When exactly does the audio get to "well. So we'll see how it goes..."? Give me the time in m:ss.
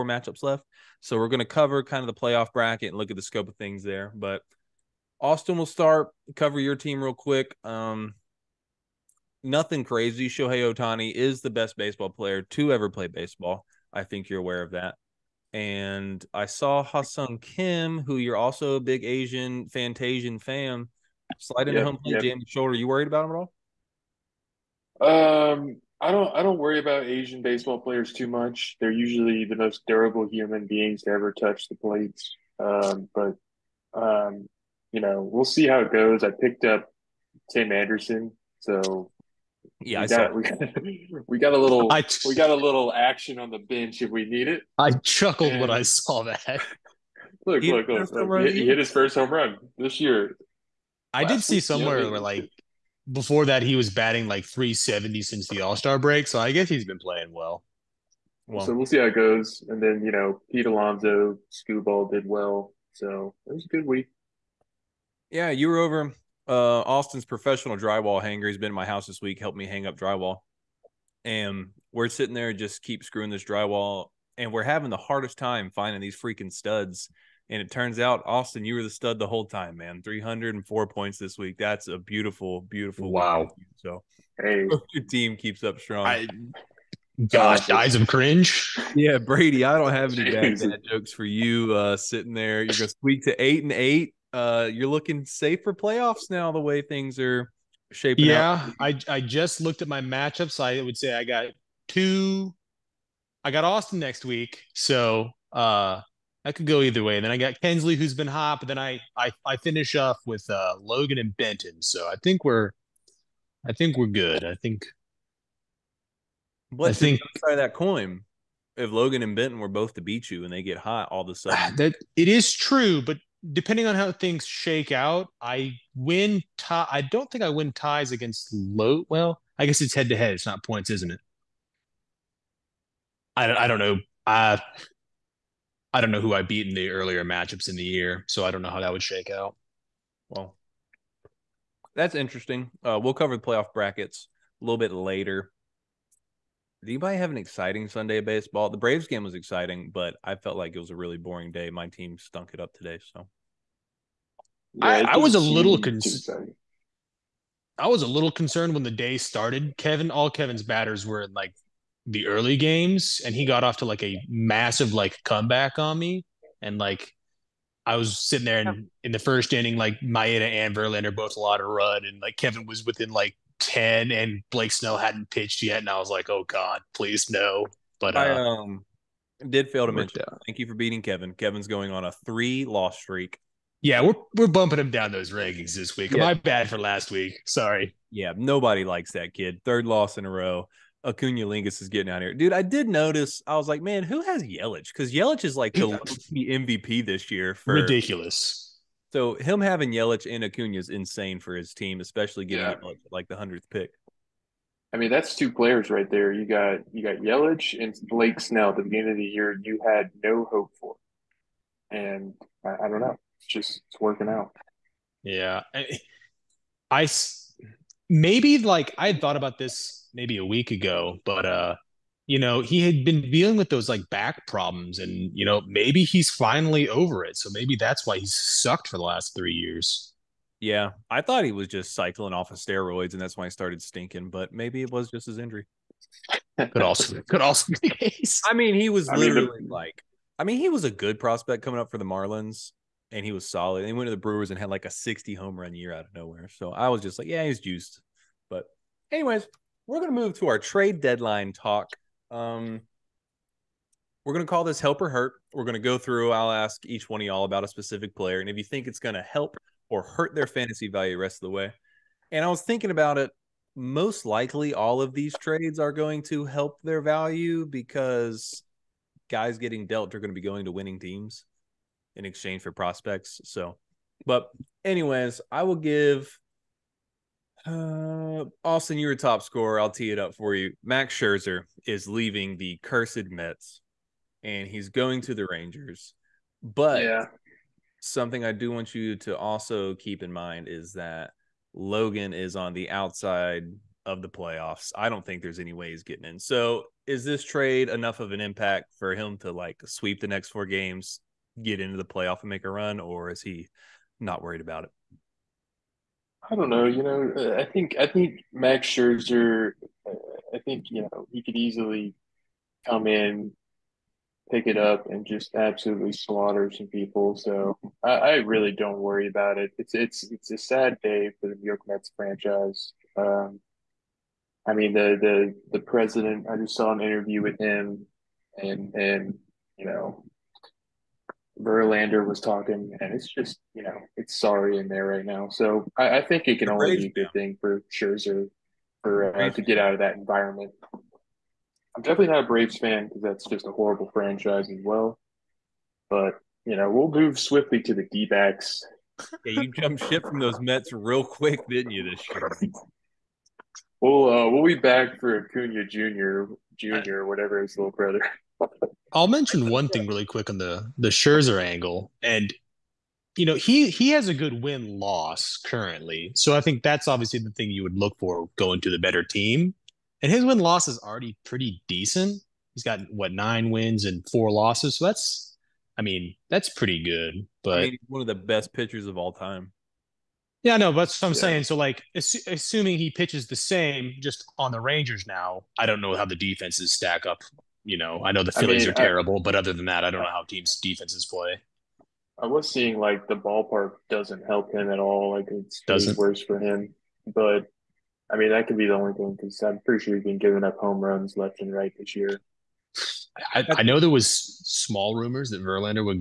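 0:58.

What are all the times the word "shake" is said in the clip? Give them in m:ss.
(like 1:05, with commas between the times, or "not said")
2:04, 2:19.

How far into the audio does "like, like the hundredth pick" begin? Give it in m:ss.
3:22.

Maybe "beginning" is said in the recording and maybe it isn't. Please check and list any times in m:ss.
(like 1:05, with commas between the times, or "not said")
3:28.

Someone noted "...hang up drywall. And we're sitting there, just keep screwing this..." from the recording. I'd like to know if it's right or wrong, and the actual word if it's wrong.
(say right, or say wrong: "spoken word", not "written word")
right.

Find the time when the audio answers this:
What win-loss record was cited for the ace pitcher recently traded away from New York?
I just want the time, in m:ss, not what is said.
6:13.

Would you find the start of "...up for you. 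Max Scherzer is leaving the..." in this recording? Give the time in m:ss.
4:40.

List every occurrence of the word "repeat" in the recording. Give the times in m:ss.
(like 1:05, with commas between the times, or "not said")
not said.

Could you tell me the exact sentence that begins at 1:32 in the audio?
You're going to squeak to eight and eight uh, you're looking safe for playoffs now.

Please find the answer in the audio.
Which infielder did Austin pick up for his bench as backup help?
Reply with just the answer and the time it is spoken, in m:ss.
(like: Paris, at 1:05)
Tim Anderson, at 0:37.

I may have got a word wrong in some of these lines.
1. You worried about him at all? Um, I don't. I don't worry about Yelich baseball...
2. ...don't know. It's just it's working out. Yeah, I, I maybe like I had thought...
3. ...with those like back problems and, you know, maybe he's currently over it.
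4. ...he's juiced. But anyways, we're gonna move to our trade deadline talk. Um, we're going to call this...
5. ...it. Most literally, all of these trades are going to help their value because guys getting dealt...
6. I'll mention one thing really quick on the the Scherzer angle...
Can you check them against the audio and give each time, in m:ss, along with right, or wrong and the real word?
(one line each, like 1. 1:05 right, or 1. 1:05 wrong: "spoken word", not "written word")
1. 0:22 wrong: "Asian", not "Yelich"
2. 3:32 right
3. 3:43 wrong: "finally", not "currently"
4. 4:07 right
5. 4:23 wrong: "likely", not "literally"
6. 5:59 right.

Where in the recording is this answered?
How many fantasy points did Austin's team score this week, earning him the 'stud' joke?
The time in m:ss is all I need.
1:20.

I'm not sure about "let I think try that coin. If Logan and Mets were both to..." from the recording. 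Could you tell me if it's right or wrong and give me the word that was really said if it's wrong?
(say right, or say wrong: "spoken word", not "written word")
wrong: "Benton", not "Mets".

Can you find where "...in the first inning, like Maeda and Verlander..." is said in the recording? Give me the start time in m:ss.
2:49.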